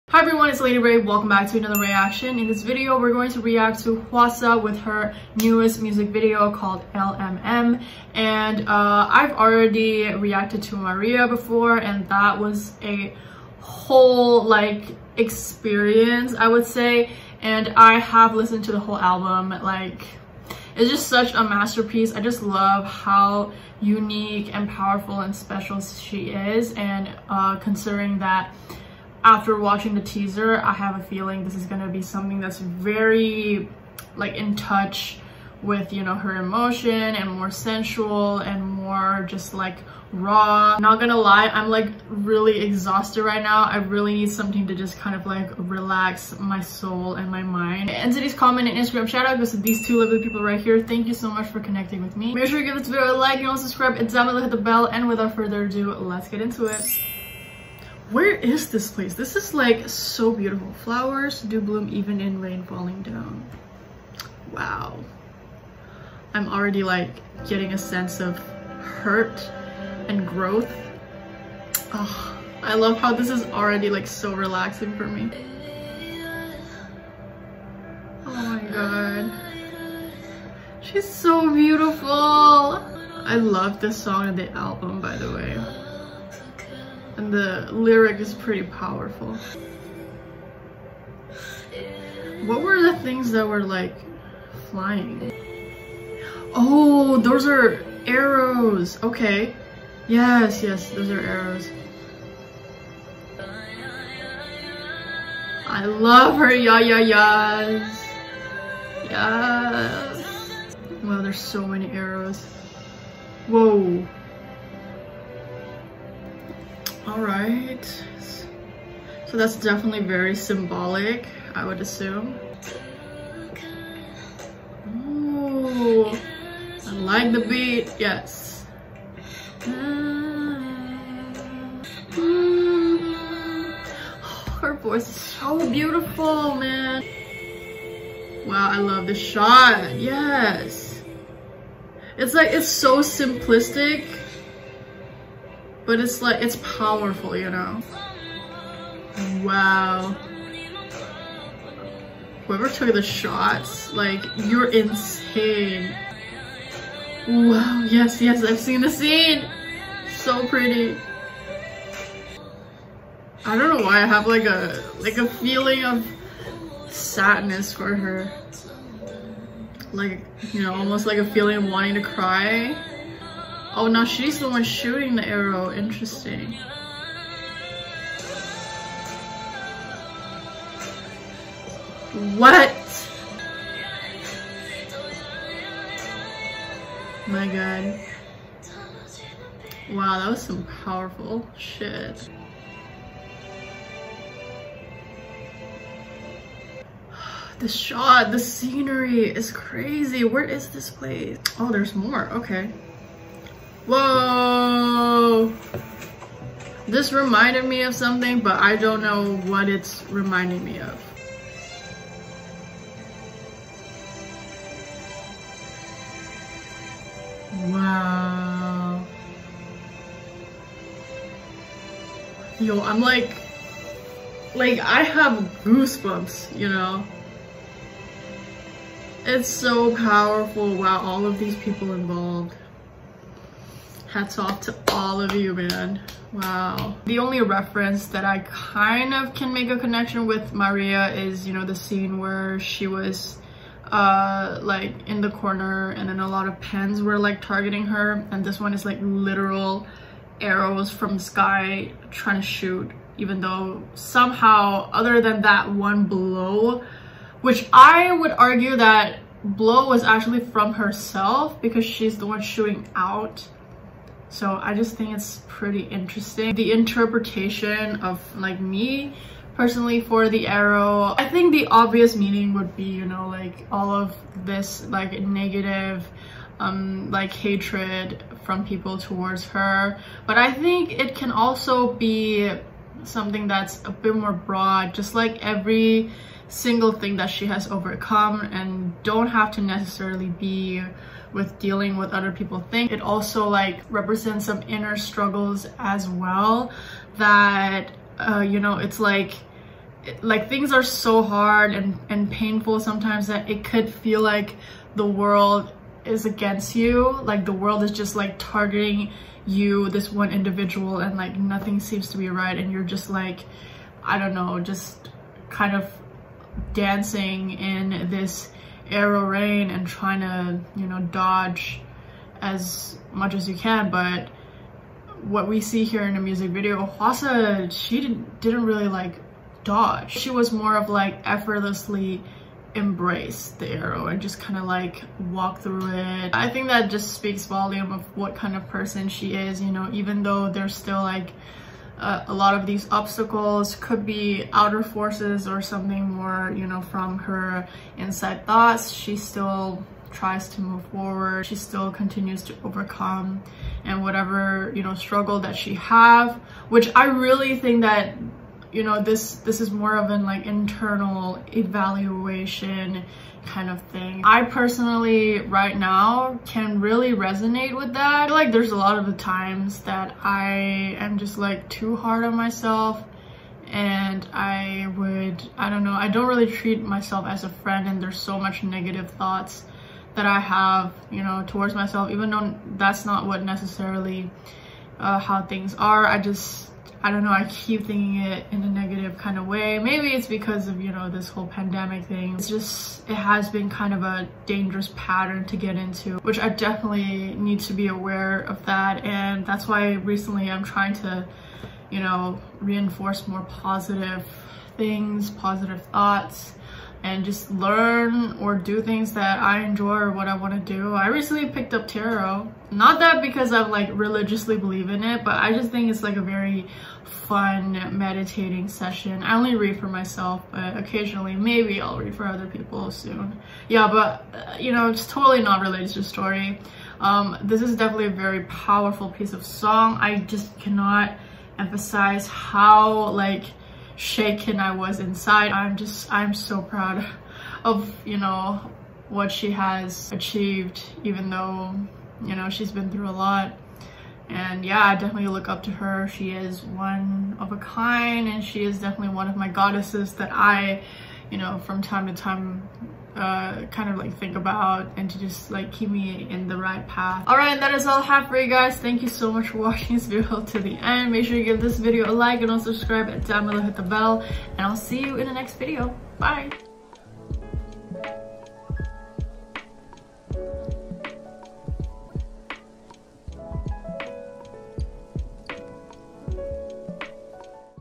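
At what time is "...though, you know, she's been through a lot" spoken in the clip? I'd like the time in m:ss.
7:21.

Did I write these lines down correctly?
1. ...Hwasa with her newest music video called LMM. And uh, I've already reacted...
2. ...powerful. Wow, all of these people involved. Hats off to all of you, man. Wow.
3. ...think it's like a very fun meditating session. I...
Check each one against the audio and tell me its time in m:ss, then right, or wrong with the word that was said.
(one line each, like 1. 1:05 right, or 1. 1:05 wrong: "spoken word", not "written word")
1. 0:04 right
2. 3:49 right
3. 6:55 right.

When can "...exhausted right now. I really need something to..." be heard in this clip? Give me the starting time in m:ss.
0:42.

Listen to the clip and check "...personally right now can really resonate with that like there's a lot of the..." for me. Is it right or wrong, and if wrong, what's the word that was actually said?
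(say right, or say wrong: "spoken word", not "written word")
right.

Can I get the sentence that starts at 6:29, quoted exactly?
Maybe it's because of, you know, this whole pandemic thing.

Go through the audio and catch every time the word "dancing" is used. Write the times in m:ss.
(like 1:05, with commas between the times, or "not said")
5:16.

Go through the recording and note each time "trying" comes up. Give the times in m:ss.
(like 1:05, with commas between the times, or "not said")
4:12, 5:19, 6:40.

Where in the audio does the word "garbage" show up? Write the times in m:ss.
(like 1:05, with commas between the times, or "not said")
not said.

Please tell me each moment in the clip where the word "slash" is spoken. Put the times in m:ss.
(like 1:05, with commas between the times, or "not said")
not said.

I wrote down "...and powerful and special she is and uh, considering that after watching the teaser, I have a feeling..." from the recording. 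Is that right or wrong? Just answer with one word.
right.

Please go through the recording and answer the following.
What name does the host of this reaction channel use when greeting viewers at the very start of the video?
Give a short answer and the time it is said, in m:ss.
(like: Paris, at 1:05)
Lady Rei, at 0:00.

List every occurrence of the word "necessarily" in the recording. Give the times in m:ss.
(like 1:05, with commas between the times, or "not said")
4:49, 6:23.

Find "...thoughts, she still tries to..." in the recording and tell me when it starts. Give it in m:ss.
5:48.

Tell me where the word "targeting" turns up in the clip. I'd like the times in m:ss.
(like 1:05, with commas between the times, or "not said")
4:07, 5:08.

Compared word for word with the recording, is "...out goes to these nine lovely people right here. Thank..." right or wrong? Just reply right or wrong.
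wrong.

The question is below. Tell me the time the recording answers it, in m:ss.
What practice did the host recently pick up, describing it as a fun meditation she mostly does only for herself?
6:51.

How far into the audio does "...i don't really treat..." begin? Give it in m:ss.
6:15.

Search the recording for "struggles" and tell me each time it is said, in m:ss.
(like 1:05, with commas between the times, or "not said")
4:54, 5:54.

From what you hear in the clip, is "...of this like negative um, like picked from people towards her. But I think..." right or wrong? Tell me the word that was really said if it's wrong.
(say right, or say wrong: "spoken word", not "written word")
wrong: "hatred", not "picked".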